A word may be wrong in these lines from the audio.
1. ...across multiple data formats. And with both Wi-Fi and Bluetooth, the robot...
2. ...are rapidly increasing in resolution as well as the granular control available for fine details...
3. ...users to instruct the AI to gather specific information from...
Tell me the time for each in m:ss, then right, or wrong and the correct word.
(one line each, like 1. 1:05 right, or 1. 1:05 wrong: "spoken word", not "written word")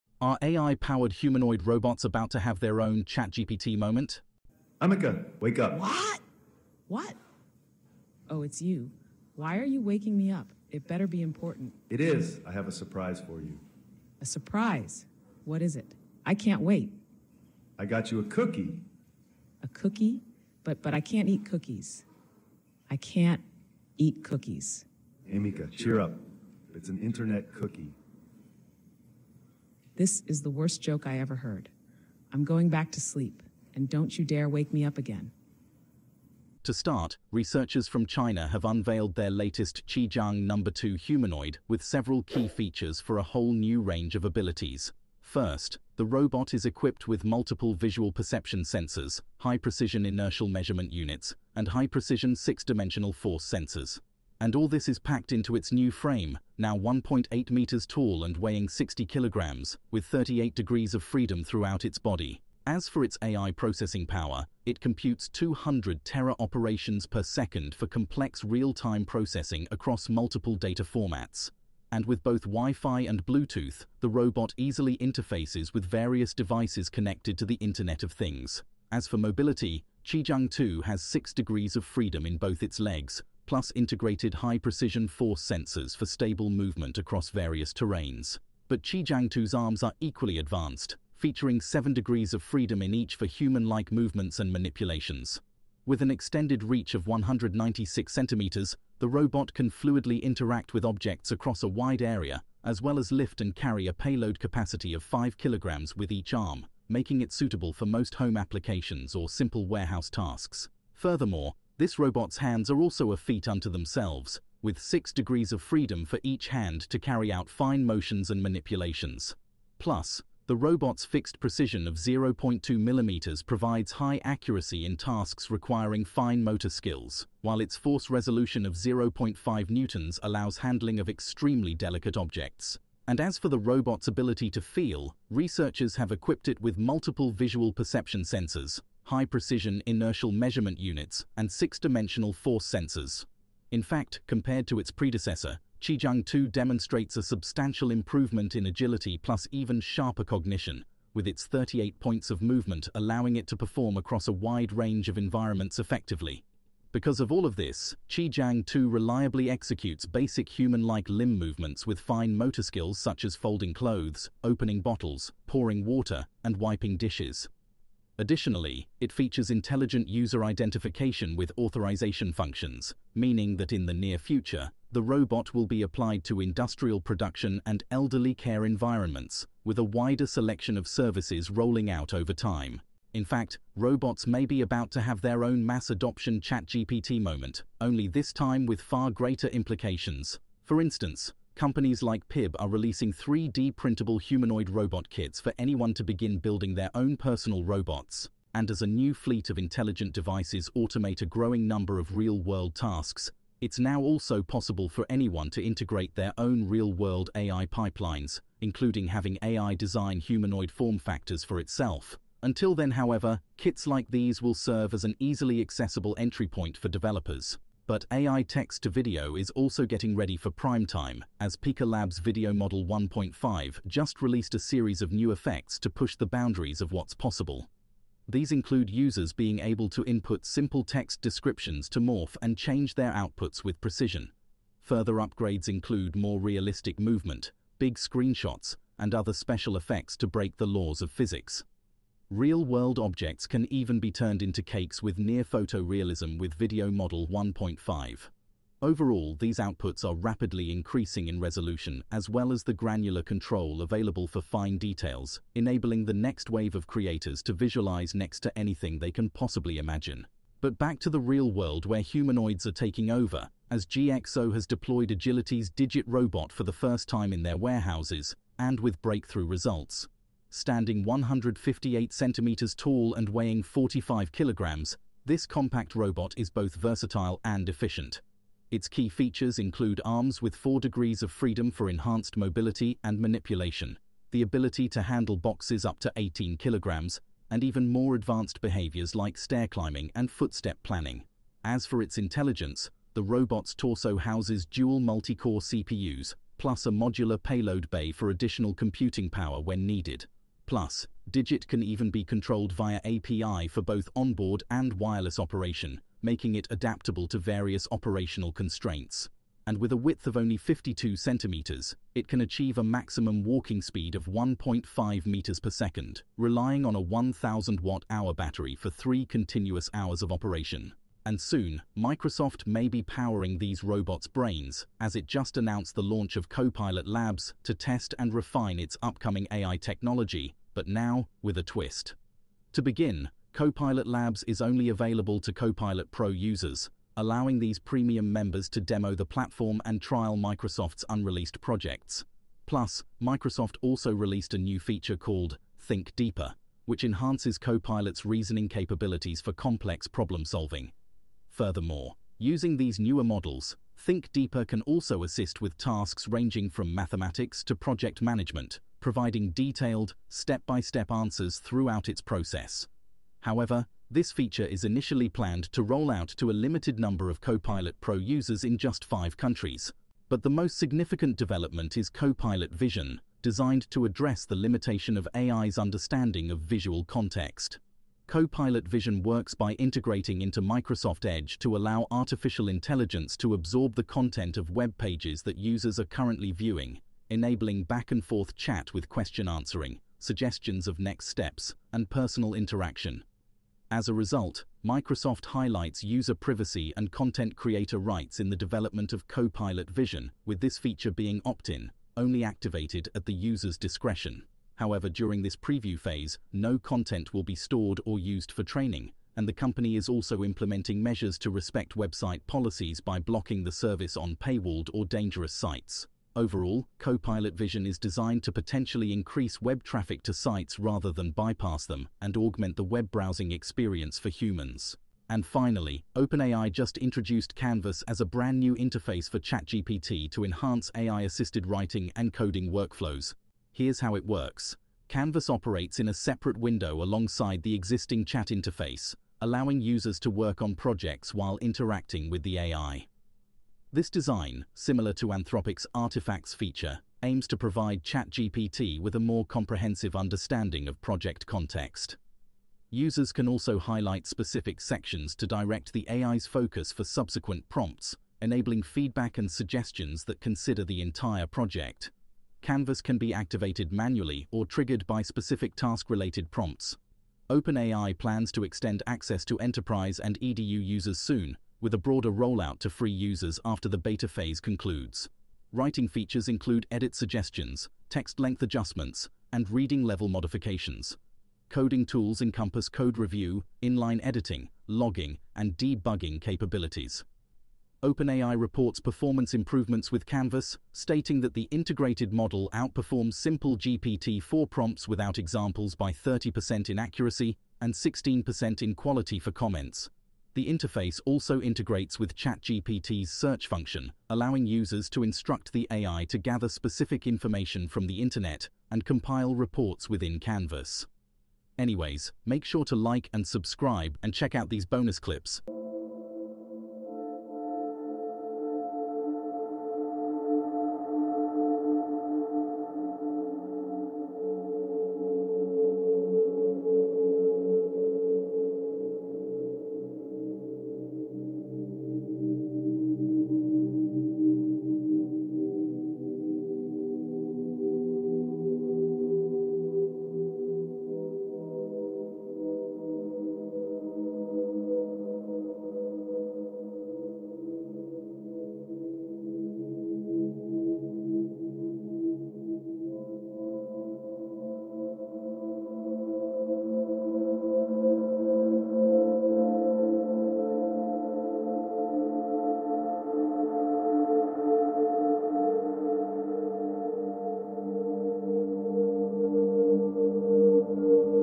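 1. 1:09 right
2. 4:10 right
3. 8:24 right.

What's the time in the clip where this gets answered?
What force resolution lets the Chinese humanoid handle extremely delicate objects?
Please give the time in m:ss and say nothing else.
2:08.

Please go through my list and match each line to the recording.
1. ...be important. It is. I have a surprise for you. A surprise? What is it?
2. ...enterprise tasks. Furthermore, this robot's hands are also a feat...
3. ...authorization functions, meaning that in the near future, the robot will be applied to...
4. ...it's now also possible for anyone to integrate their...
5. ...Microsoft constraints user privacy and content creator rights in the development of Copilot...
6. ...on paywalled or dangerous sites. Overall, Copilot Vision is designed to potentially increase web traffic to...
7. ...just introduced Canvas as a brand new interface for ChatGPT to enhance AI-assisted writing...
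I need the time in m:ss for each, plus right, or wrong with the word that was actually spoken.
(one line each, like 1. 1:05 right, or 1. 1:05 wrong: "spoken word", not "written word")
1. 0:11 right
2. 1:49 wrong: "warehouse", not "enterprise"
3. 2:51 right
4. 3:23 right
5. 6:34 wrong: "highlights", not "constraints"
6. 6:54 right
7. 7:06 right.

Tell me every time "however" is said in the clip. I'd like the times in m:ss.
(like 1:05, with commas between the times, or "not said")
3:32, 6:03, 6:44.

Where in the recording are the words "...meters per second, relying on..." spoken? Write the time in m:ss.
5:15.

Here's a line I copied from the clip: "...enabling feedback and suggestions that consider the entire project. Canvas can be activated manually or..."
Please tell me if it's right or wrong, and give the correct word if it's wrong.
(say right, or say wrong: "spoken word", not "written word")
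right.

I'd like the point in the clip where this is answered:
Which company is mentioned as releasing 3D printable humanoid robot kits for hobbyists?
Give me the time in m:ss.
3:12.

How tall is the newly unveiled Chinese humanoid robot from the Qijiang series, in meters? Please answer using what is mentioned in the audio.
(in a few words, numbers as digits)
1.8 meters.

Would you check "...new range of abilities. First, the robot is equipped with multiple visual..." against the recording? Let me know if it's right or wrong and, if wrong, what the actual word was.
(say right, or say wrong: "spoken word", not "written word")
right.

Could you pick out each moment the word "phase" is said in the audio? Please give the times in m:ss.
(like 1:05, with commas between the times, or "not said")
6:45, 7:54.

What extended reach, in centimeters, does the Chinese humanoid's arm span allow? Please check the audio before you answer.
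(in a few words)
196 centimeters.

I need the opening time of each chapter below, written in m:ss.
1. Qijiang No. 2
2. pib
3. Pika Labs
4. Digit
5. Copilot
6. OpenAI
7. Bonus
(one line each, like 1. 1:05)
1. 0:36
2. 3:10
3. 3:38
4. 4:20
5. 5:21
6. 7:05
7. 8:32.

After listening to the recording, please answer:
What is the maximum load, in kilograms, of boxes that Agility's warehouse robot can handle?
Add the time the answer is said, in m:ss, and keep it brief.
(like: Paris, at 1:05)
18 kilograms, at 4:46.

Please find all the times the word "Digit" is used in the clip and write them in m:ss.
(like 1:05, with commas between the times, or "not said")
4:25, 5:01.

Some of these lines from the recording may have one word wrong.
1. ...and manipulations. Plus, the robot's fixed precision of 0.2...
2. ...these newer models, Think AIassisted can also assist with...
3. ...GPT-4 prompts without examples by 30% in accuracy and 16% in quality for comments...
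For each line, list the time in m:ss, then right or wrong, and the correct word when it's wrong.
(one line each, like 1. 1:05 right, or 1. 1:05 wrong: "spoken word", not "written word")
1. 1:58 right
2. 5:52 wrong: "Deeper", not "AIassisted"
3. 8:13 right.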